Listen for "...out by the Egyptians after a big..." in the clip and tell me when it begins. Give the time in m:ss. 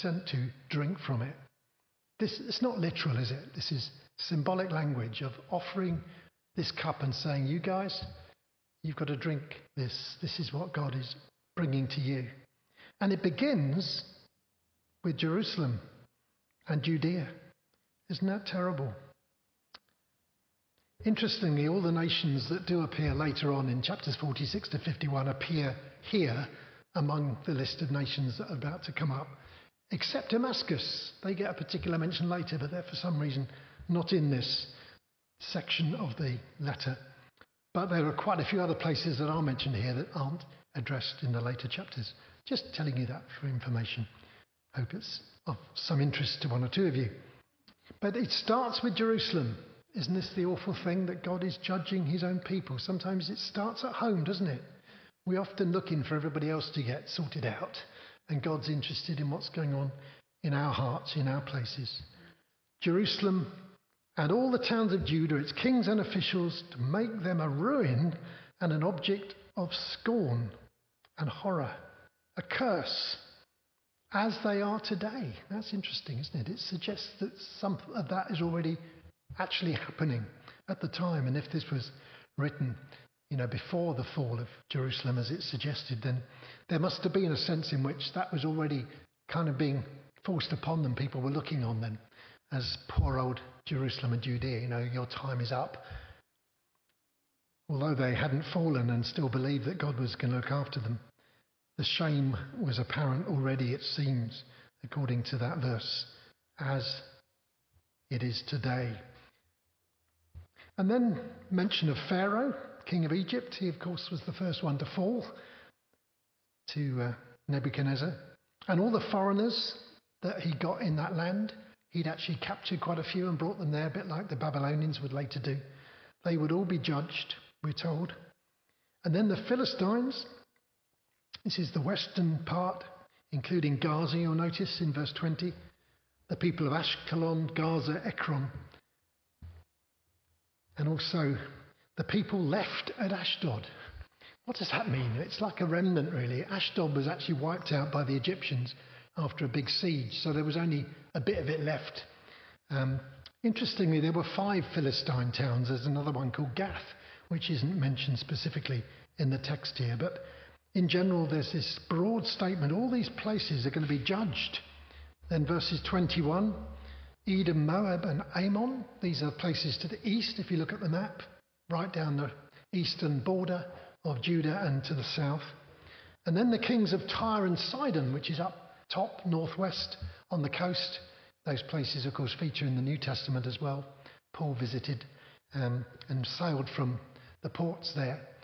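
2:27.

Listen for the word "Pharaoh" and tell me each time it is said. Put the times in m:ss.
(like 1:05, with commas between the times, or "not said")
1:52.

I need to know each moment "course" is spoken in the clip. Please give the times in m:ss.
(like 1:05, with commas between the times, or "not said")
1:53, 3:02.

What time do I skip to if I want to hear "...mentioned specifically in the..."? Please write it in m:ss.
2:37.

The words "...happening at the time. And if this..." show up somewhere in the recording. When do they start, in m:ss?
1:19.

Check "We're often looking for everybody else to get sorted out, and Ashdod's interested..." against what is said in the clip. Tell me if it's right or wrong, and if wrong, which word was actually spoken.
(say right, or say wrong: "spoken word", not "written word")
wrong: "God", not "Ashdod".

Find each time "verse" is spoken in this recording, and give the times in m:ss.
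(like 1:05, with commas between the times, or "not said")
1:45, 2:14, 2:45.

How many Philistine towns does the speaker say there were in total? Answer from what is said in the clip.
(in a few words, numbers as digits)
5.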